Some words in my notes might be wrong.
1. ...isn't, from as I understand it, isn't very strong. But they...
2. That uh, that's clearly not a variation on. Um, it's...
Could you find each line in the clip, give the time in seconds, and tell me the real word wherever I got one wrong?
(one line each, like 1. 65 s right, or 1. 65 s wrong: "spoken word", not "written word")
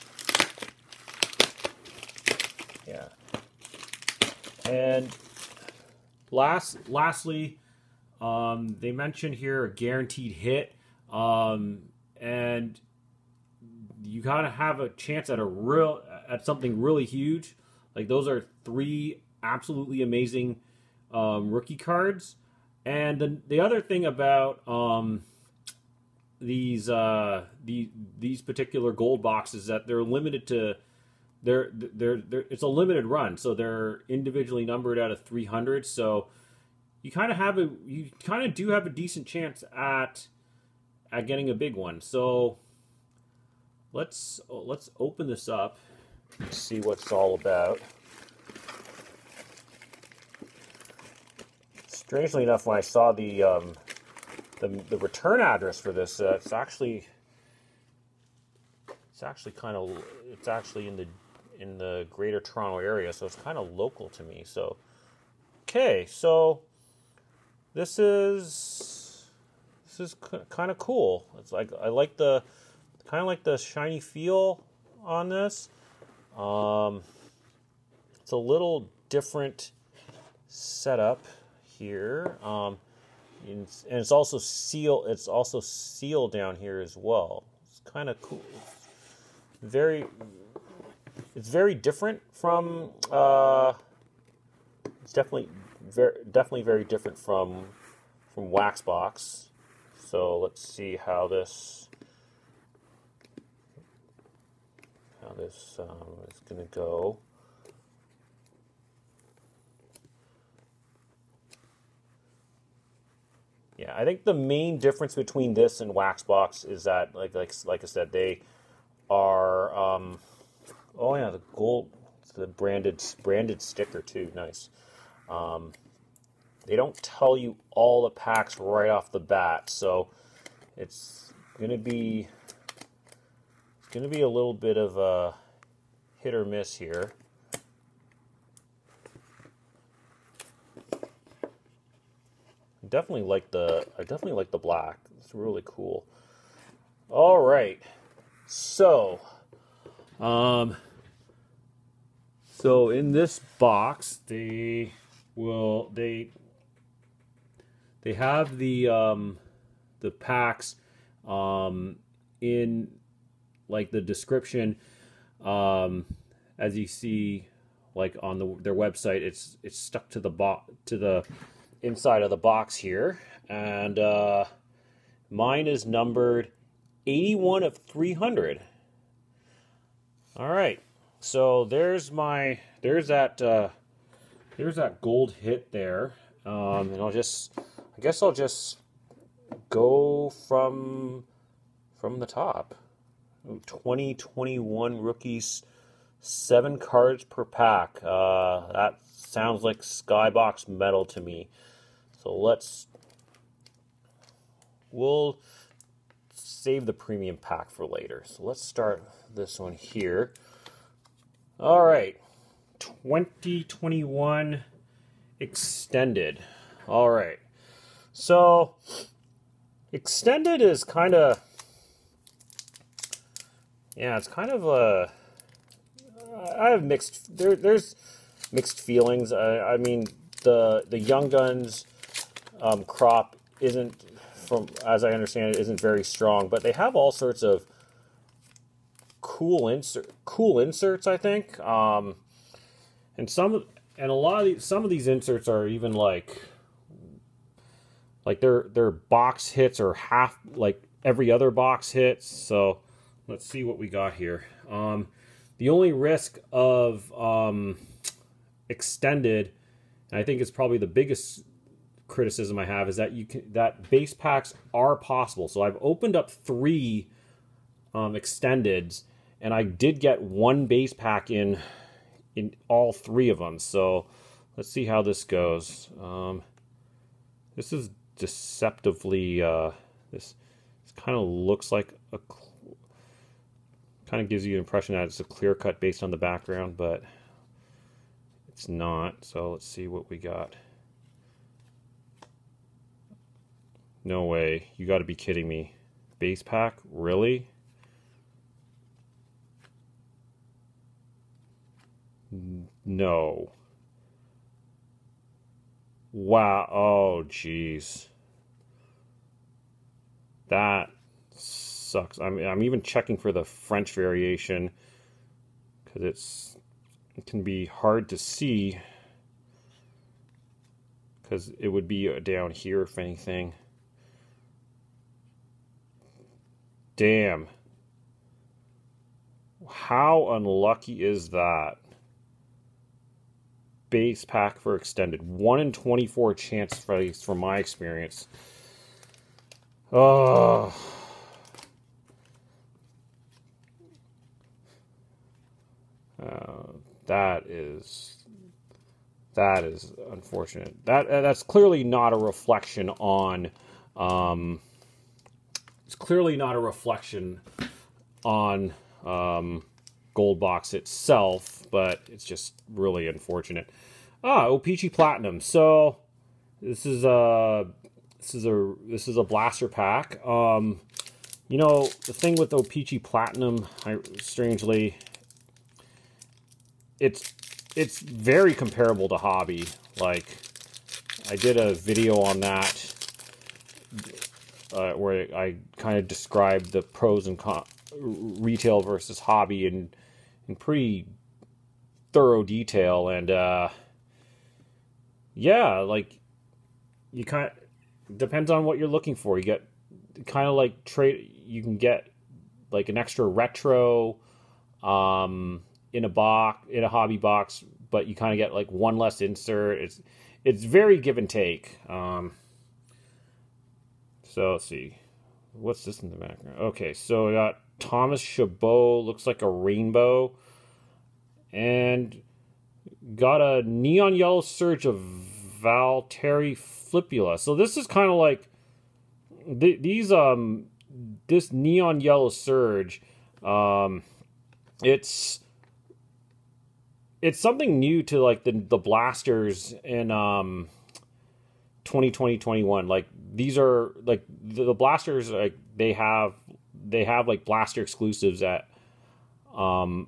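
1. 233 s right
2. 350 s wrong: "reflection", not "variation".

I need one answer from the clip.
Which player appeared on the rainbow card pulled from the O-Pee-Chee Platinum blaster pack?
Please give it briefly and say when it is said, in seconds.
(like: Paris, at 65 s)
Thomas Chabot, at 417 s.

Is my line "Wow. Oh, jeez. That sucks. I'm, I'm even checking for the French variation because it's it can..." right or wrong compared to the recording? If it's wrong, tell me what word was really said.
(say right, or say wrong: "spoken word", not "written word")
right.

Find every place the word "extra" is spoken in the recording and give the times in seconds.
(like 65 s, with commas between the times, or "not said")
402 s.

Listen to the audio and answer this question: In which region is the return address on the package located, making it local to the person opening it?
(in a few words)
Greater Toronto area.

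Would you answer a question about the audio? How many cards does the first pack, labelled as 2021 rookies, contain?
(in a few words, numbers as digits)
7.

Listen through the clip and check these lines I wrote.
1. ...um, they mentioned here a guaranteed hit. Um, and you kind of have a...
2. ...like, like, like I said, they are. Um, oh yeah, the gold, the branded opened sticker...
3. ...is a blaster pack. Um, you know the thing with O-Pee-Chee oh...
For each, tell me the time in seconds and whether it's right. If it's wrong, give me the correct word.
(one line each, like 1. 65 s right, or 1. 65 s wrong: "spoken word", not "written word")
1. 8 s right
2. 117 s wrong: "branded", not "opened"
3. 369 s right.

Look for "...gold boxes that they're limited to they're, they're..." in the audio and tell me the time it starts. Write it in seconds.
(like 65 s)
28 s.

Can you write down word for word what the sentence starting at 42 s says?
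So Let's, oh, let's open this up and see what it's all about.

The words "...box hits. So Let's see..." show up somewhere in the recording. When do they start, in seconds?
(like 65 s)
251 s.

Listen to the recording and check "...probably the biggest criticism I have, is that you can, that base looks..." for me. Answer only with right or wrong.
wrong.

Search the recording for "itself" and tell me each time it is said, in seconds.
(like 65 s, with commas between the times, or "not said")
360 s.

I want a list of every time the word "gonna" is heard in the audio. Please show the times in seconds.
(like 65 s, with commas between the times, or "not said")
131 s.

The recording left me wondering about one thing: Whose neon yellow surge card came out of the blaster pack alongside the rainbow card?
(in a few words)
Valtteri Filppula.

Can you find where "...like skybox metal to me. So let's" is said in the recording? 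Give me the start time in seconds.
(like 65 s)
199 s.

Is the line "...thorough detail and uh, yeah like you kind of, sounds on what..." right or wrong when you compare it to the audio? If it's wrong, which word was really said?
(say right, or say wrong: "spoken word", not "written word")
wrong: "depends", not "sounds".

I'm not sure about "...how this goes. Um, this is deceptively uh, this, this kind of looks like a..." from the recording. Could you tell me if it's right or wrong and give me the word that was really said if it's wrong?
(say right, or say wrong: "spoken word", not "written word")
right.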